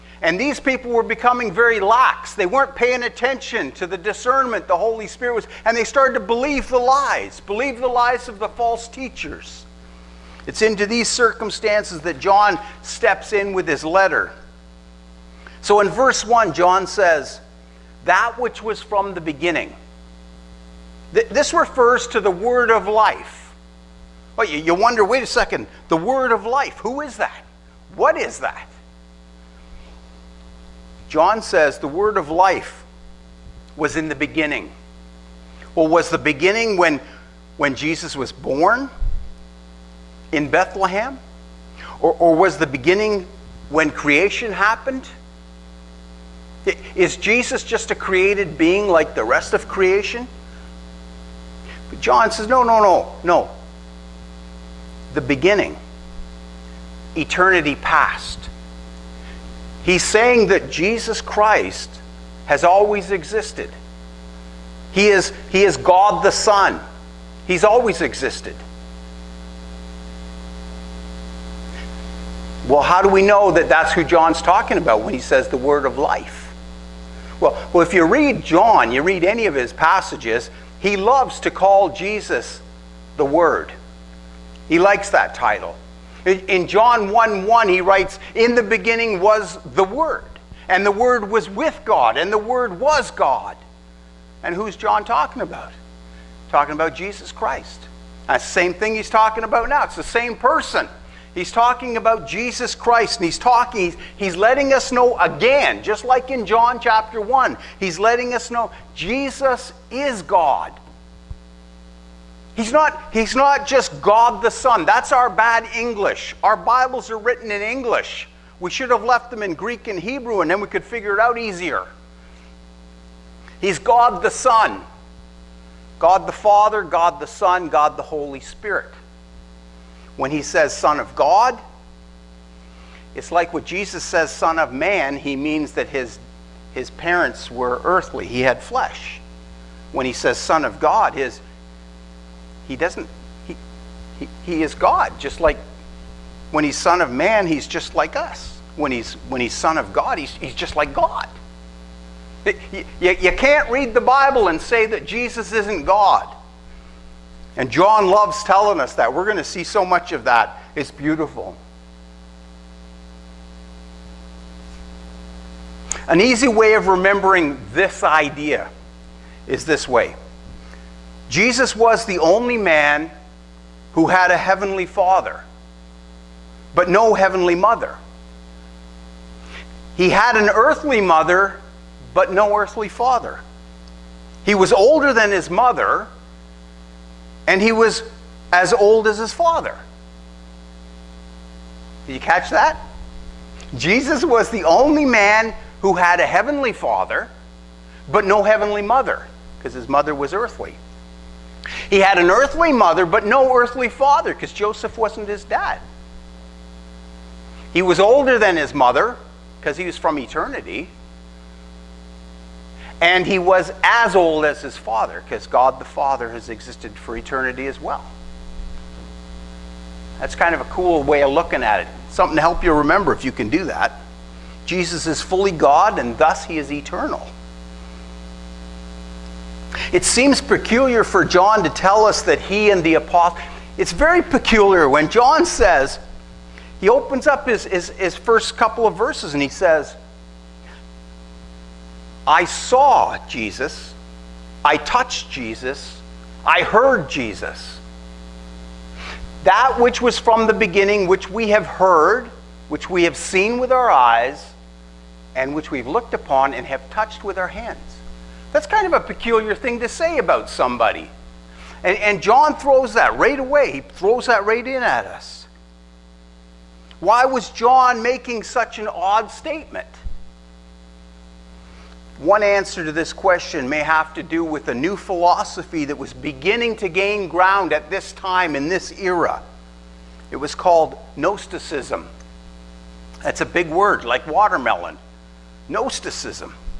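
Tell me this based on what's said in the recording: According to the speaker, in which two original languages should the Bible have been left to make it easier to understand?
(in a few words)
Greek and Hebrew.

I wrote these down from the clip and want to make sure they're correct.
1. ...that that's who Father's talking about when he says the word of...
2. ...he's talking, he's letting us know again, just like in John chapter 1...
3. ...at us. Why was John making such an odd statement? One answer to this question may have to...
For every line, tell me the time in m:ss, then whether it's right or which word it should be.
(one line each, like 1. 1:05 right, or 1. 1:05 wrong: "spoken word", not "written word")
1. 1:13 wrong: "John", not "Father"
2. 1:43 right
3. 4:24 right.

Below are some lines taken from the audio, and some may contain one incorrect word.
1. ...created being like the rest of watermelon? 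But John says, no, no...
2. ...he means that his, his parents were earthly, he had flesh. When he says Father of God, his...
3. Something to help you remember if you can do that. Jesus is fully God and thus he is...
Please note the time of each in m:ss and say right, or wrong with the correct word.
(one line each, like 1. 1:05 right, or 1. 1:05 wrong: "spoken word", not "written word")
1. 0:47 wrong: "creation", not "watermelon"
2. 2:15 wrong: "Son", not "Father"
3. 3:42 right.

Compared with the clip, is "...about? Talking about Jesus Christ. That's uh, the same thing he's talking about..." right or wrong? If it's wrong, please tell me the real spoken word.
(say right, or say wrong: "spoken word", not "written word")
right.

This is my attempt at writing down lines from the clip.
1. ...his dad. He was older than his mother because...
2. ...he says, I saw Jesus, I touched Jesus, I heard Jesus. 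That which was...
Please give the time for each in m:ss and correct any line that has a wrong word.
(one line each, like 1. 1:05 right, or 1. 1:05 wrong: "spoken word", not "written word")
1. 3:25 right
2. 3:59 right.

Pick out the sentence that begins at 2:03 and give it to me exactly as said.
He's God the Son, God the Father, God the Son, God the Holy Spirit.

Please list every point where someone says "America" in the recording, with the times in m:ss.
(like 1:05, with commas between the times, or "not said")
not said.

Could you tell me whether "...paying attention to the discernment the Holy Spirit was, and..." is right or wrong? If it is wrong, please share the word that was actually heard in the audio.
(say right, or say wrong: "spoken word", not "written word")
right.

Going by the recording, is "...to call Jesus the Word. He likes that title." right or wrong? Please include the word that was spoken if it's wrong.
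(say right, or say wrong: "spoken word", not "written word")
right.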